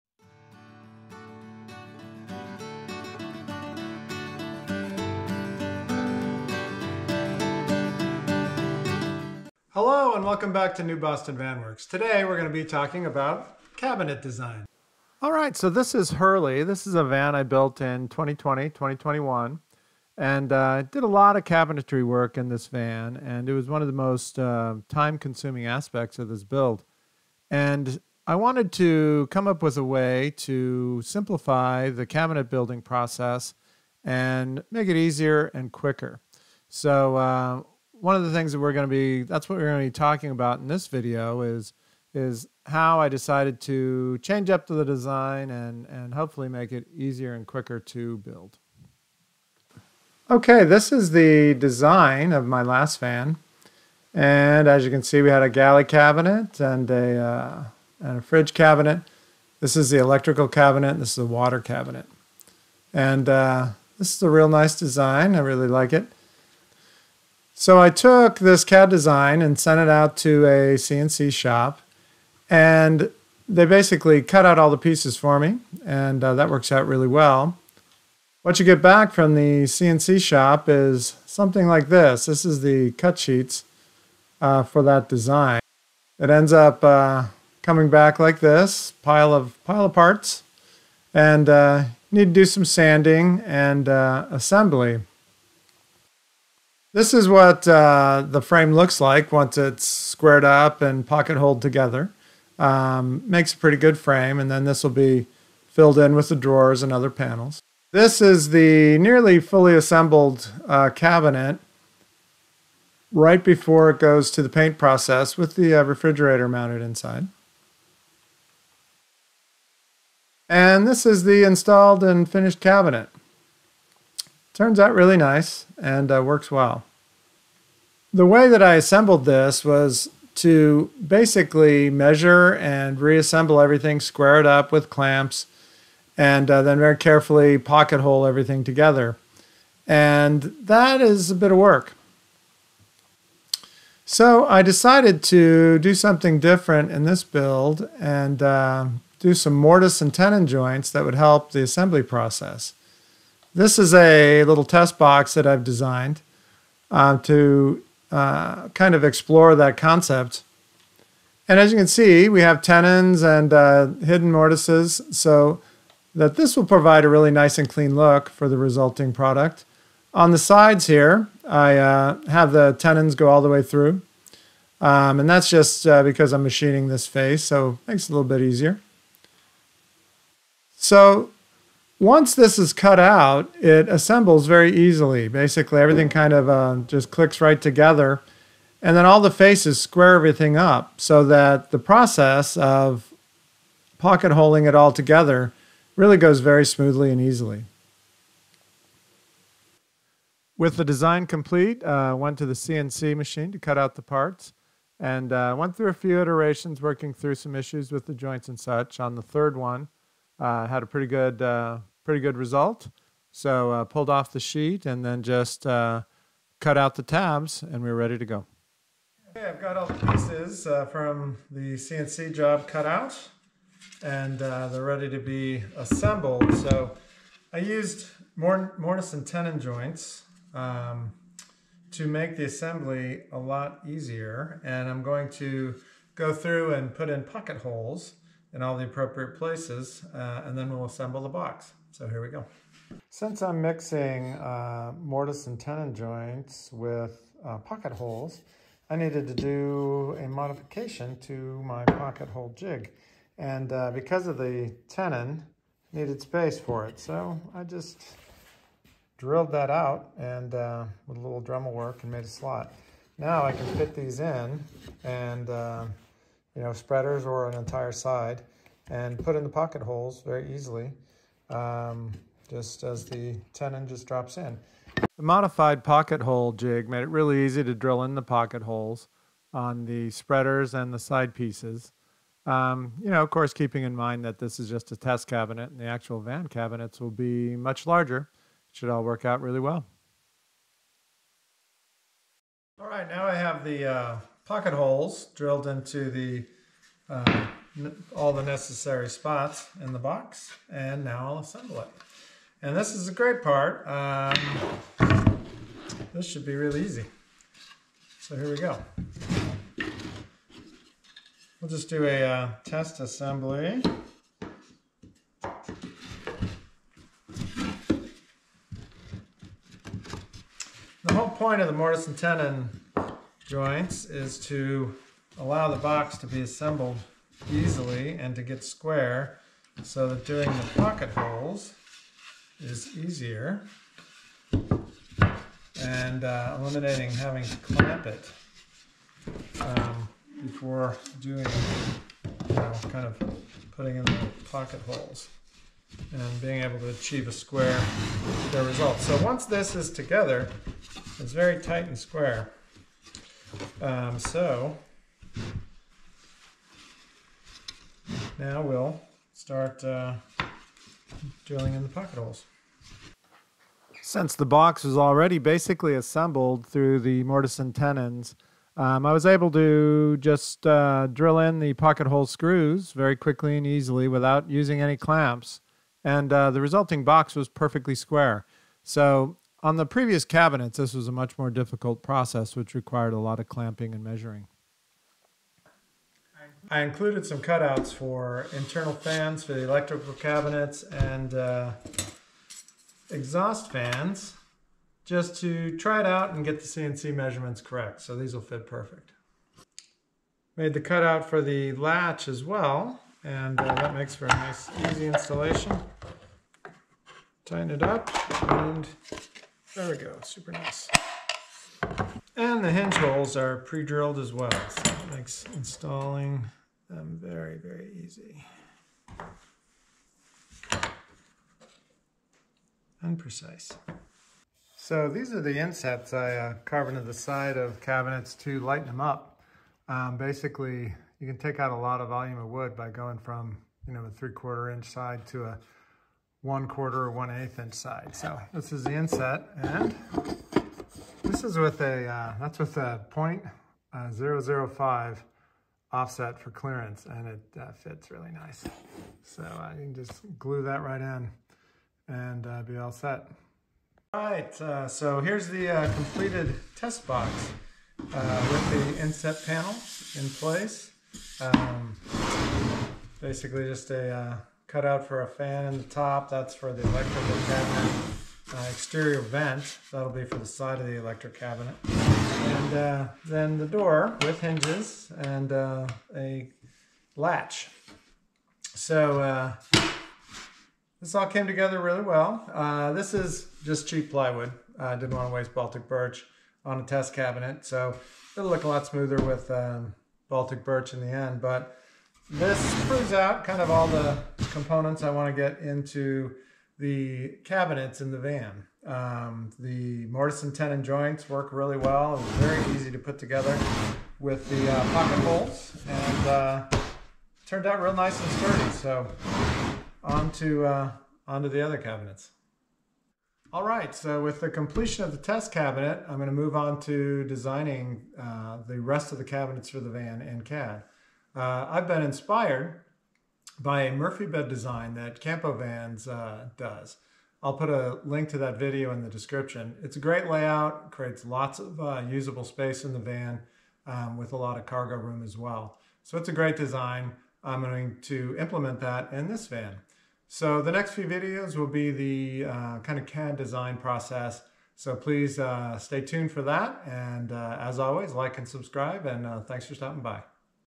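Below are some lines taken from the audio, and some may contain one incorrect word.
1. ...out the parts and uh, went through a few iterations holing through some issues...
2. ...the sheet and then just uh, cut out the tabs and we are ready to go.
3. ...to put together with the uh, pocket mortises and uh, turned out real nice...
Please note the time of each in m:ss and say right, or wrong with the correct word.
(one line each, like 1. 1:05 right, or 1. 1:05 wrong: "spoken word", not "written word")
1. 3:23 wrong: "working", not "holing"
2. 3:34 right
3. 8:22 wrong: "holes", not "mortises".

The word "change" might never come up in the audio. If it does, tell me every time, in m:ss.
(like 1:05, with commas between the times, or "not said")
0:44.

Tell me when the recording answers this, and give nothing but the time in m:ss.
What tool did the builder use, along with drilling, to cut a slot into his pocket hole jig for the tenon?
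4:21.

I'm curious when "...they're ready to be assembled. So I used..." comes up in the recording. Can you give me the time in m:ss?
3:44.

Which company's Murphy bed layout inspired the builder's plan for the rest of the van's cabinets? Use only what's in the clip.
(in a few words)
Campo Vans.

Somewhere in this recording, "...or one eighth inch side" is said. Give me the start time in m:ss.
7:17.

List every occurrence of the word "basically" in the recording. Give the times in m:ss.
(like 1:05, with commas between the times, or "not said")
1:13, 2:11, 3:05, 6:05, 7:10, 7:43.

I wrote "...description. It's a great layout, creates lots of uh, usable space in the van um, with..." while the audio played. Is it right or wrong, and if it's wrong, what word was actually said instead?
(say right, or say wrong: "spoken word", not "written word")
right.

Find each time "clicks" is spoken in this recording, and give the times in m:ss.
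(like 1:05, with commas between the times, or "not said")
3:07.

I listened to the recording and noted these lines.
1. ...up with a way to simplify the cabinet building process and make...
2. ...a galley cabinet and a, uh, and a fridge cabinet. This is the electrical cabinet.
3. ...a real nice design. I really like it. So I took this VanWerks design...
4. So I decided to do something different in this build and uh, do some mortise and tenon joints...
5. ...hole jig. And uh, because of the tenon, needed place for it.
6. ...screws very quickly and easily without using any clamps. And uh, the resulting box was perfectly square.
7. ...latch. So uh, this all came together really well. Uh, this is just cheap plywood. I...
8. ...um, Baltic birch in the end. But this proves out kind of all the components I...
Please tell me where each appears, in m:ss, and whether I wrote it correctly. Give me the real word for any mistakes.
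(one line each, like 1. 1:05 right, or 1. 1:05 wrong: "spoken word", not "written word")
1. 0:29 right
2. 0:55 right
3. 1:04 wrong: "CAD", not "VanWerks"
4. 2:24 right
5. 4:12 wrong: "space", not "place"
6. 6:12 right
7. 7:57 right
8. 8:09 right.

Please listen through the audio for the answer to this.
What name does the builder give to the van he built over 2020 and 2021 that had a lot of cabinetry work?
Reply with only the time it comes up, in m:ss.
0:16.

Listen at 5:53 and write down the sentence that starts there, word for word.
Um, so now we'll start uh, drilling in the pocket holes.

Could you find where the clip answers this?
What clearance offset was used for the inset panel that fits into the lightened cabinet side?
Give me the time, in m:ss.
7:25.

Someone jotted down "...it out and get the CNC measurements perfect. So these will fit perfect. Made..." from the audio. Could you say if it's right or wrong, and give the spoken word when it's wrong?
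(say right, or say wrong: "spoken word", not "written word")
wrong: "correct", not "perfect".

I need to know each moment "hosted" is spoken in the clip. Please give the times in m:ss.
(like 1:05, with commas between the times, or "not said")
not said.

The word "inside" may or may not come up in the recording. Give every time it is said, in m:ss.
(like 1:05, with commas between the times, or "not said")
1:56.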